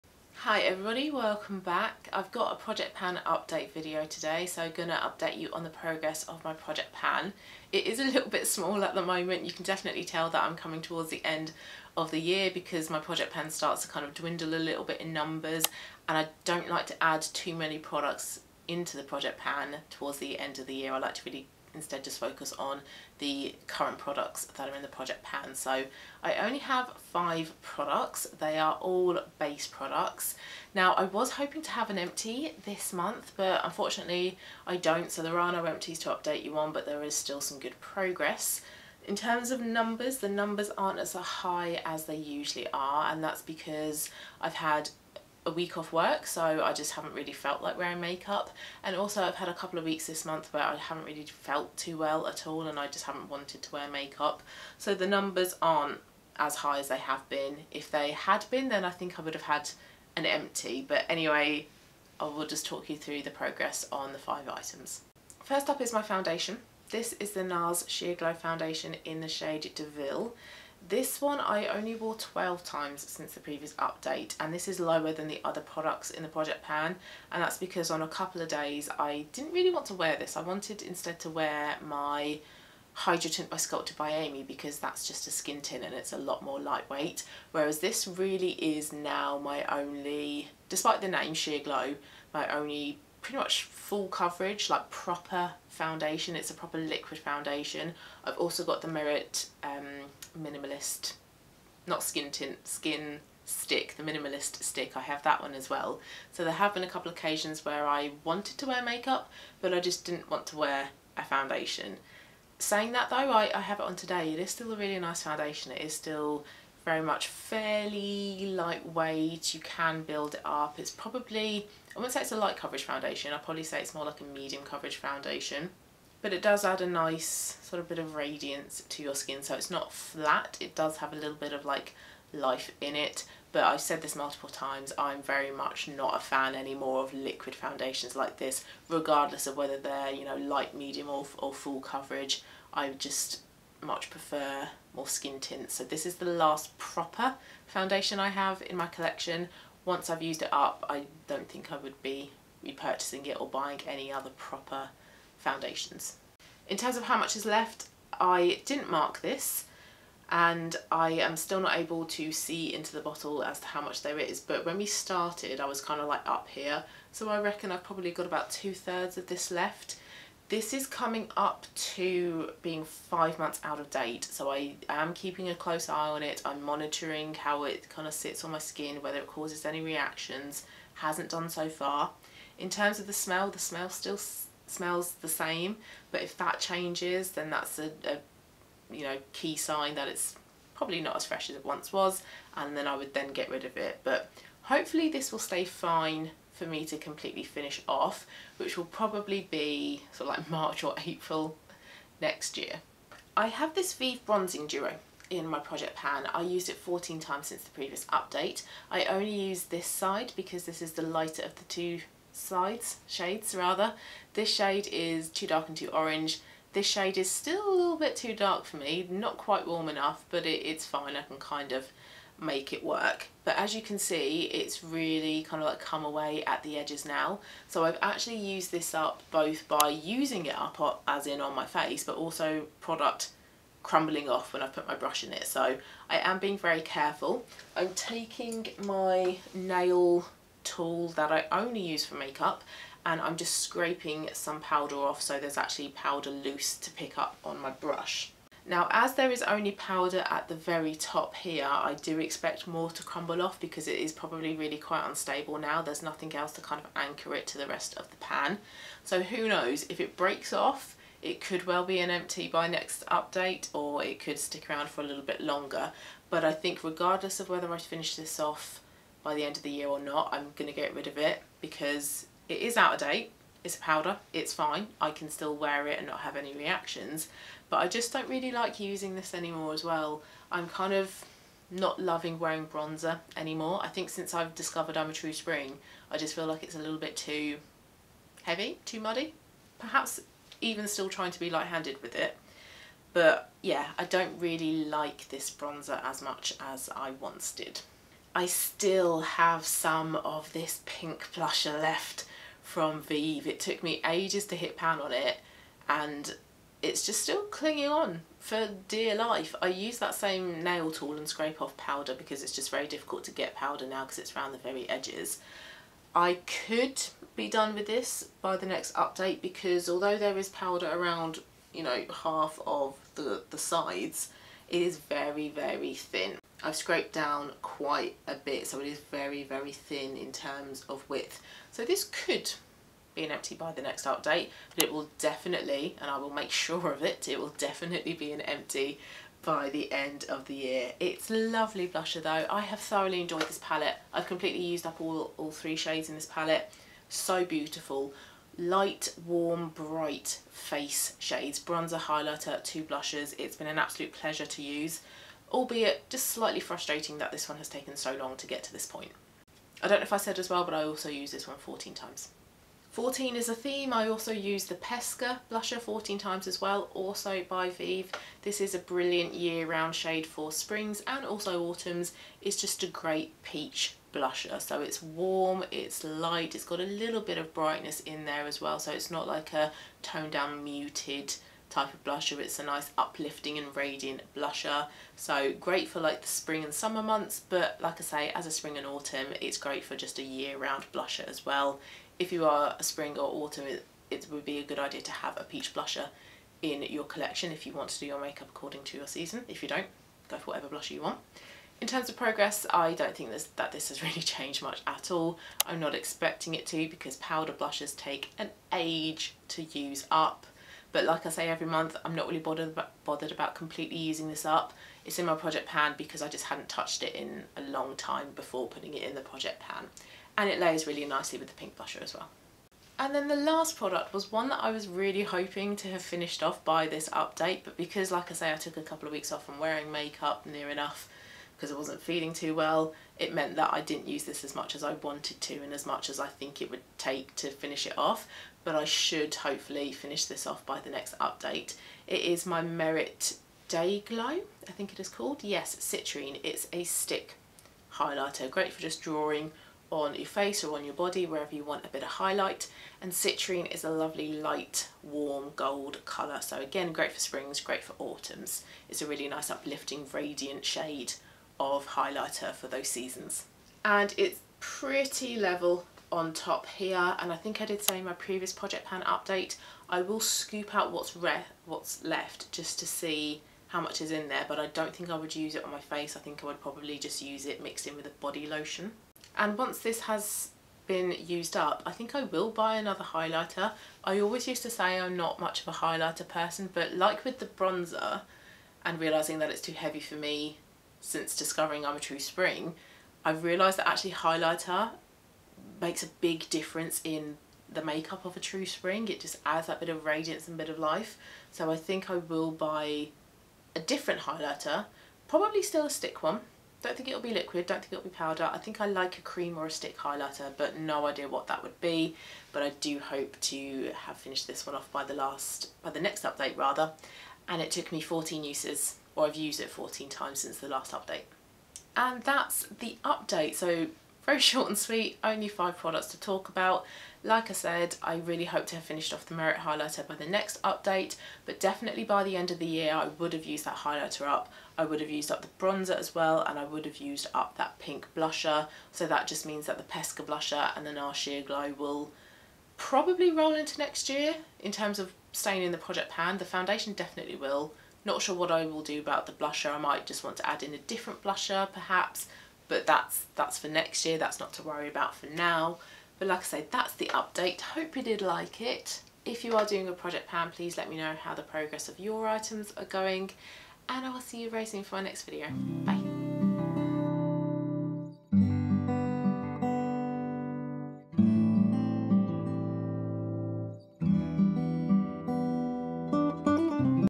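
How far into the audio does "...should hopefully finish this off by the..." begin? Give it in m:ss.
7:18.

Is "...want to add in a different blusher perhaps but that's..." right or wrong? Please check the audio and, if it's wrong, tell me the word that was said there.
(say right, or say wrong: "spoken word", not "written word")
right.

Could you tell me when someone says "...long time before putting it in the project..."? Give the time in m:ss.
6:57.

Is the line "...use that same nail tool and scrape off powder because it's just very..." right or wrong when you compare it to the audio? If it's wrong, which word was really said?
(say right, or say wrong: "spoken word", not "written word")
right.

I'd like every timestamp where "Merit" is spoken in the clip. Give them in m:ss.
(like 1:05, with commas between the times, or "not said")
1:38, 7:22, 8:49.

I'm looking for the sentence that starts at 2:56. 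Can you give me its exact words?
I'm monitoring how it kind of sits on my skin, whether it causes any reactions.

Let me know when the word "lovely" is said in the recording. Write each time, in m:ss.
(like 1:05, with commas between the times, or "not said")
5:41, 7:33.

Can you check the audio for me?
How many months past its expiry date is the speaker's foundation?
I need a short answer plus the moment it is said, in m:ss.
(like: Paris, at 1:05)
5, at 2:52.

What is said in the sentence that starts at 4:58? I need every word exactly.
I still have some of this pink blusher left from Vieve.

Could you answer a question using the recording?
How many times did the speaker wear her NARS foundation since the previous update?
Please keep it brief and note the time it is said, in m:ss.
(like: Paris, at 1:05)
12, at 1:12.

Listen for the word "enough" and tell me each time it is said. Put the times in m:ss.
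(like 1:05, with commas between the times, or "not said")
3:39, 7:10.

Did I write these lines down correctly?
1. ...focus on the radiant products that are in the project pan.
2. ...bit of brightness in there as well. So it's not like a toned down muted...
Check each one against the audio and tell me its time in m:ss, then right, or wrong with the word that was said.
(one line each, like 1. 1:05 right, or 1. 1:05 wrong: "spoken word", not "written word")
1. 0:22 wrong: "current", not "radiant"
2. 6:17 right.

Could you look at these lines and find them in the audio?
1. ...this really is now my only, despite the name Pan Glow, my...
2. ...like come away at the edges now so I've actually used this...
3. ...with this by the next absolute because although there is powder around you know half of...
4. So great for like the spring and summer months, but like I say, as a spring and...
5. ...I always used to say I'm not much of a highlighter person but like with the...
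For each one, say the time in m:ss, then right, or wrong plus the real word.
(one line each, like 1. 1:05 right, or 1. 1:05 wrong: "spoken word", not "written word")
1. 1:27 wrong: "Sheer", not "Pan"
2. 3:45 right
3. 5:17 wrong: "update", not "absolute"
4. 6:25 right
5. 8:04 right.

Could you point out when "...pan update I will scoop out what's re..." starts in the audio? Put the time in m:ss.
7:48.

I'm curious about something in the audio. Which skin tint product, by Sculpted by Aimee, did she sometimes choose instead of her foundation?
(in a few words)
Hydrotint.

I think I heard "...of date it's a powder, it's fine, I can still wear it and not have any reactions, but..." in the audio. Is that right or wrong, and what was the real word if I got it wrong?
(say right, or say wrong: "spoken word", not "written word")
right.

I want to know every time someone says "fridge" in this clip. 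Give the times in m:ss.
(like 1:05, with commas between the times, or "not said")
not said.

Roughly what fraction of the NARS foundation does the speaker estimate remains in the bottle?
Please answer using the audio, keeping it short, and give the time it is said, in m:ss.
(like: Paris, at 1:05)
two thirds, at 2:48.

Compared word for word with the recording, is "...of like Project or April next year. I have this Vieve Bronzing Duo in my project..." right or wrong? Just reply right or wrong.
wrong.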